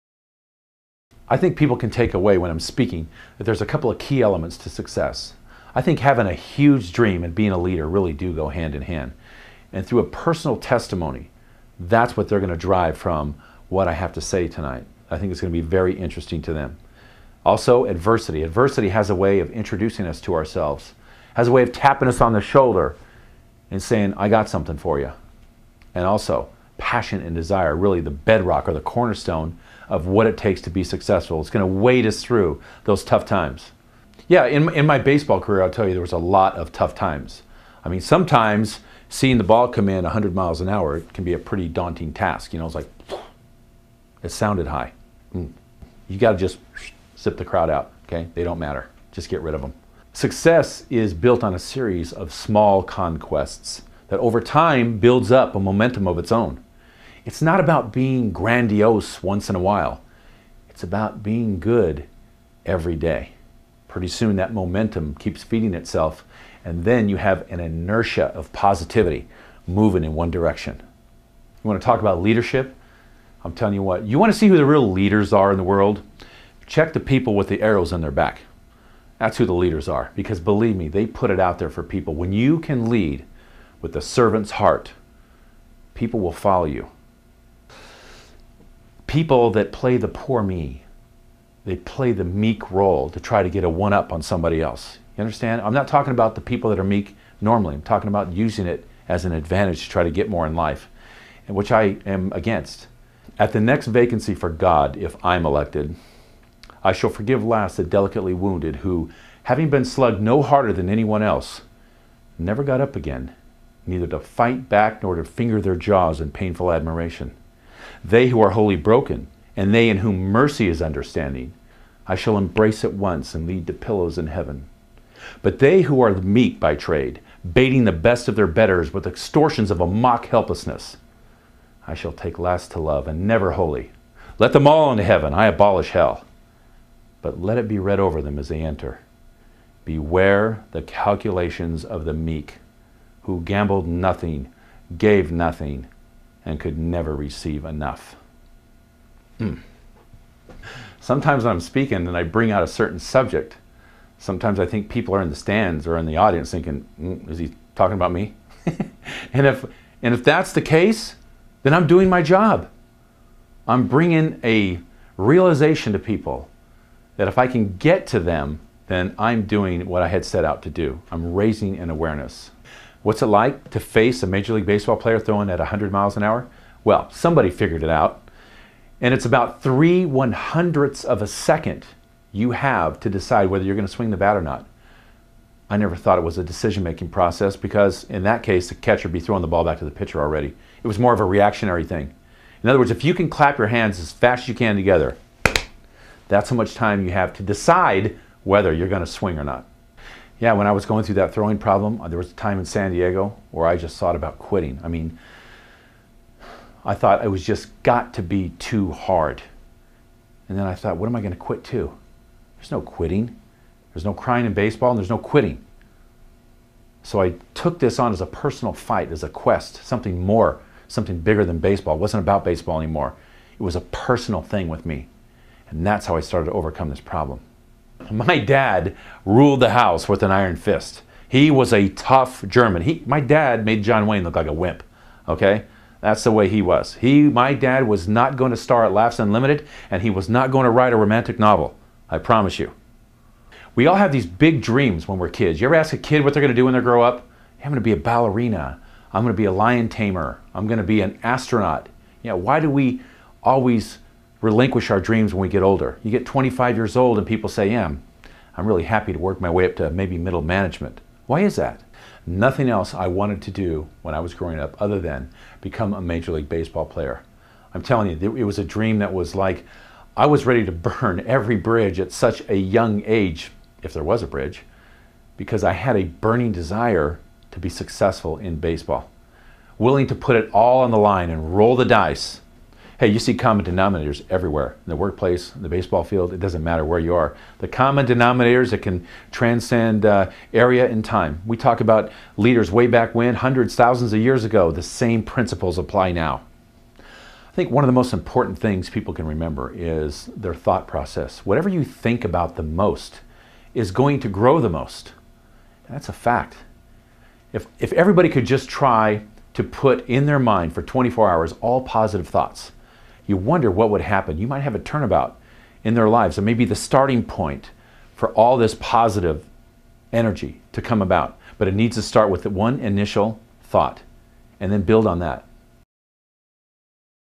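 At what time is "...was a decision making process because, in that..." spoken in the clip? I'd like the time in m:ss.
3:06.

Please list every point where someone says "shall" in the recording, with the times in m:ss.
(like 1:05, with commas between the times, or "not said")
1:46, 2:02, 2:11.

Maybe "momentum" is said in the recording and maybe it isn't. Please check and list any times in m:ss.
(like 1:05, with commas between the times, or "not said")
0:55, 1:04.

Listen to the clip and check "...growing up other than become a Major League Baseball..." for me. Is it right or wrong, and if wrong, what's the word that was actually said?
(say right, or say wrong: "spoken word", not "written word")
right.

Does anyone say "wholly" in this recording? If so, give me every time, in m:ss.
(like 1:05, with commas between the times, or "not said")
1:58, 2:13.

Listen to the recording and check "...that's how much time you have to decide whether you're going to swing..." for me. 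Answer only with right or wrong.
right.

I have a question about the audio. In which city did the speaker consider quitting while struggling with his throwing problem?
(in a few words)
San Diego.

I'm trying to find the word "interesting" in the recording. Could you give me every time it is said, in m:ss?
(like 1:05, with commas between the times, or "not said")
0:15.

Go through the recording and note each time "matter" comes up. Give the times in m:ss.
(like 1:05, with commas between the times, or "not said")
0:48, 4:46.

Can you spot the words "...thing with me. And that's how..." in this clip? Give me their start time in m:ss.
3:44.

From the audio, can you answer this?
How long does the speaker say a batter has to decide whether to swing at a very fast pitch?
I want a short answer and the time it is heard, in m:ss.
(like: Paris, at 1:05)
3 hundredths of a second, at 2:59.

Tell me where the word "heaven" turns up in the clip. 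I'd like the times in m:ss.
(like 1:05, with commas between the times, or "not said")
2:04, 2:15.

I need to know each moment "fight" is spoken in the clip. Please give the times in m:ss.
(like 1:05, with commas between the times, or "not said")
1:54, 3:38.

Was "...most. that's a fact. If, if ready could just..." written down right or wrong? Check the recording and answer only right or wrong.
wrong.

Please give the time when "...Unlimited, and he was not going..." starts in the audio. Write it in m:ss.
3:59.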